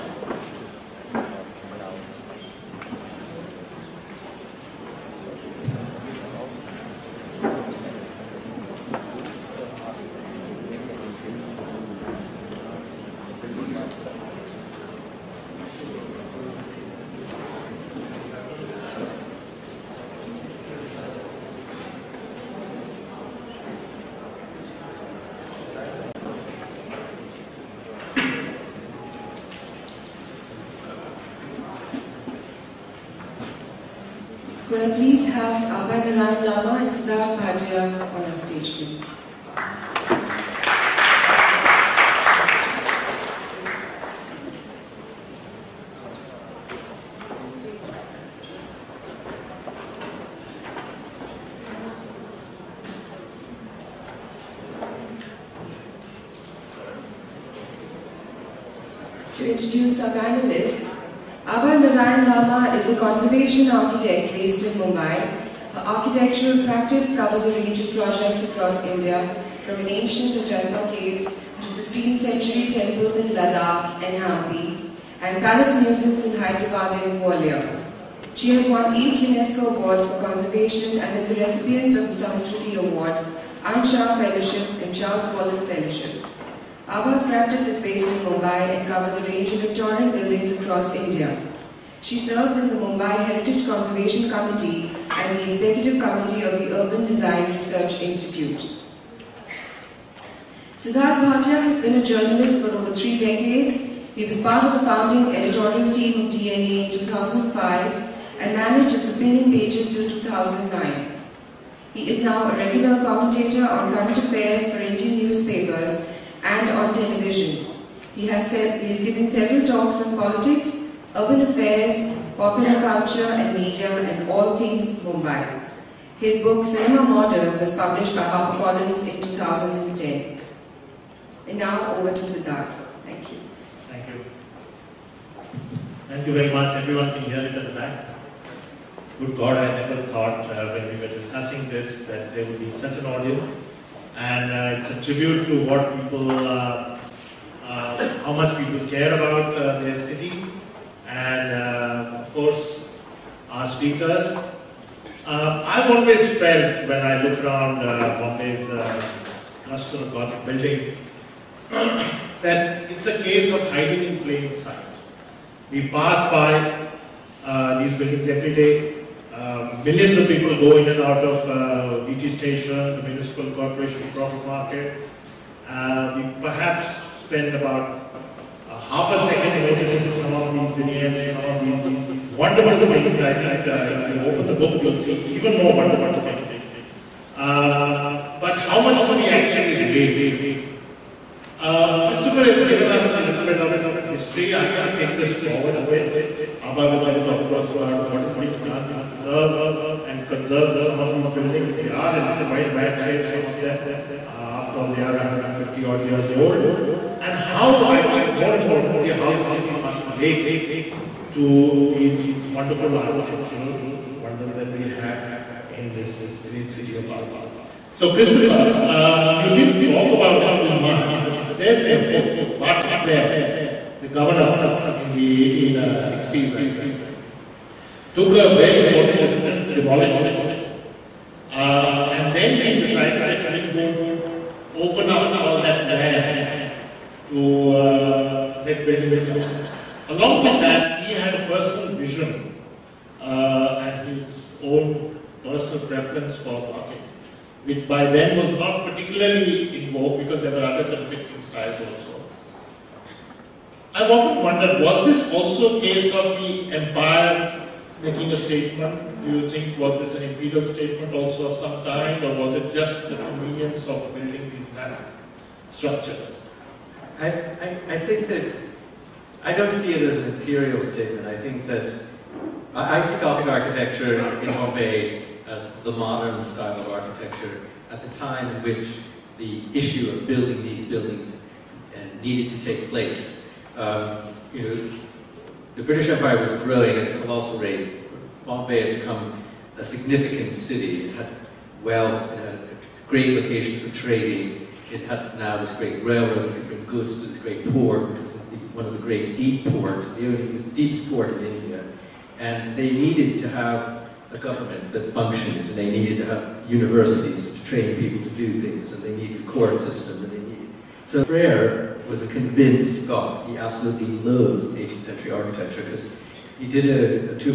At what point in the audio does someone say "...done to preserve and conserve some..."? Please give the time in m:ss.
3:18.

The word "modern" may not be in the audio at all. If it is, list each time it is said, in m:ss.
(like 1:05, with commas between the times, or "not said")
2:07, 4:35.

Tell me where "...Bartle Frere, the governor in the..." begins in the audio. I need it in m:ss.
3:42.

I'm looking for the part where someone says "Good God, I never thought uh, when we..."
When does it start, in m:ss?
2:19.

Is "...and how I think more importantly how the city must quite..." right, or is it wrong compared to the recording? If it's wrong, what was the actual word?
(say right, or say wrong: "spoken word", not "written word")
wrong: "relate", not "quite".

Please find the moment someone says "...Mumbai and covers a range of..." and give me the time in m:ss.
1:28.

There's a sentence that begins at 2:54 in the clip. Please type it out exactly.
we perhaps spend about half a second noticing some of these vignettes, some of these wonderful things.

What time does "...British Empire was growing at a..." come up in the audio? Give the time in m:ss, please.
4:45.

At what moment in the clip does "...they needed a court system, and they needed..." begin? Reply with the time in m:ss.
5:09.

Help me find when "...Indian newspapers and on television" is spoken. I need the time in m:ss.
1:54.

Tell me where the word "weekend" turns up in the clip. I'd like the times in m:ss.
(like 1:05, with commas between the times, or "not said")
not said.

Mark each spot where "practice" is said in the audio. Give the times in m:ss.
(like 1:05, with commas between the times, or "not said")
1:06, 1:27.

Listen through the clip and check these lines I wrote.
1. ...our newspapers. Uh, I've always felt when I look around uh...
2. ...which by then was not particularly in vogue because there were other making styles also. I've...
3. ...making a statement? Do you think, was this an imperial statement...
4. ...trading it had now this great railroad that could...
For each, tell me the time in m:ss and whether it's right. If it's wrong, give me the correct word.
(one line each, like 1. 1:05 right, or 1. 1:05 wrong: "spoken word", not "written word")
1. 2:33 wrong: "speakers", not "newspapers"
2. 4:07 wrong: "conflicting", not "making"
3. 4:18 right
4. 4:53 right.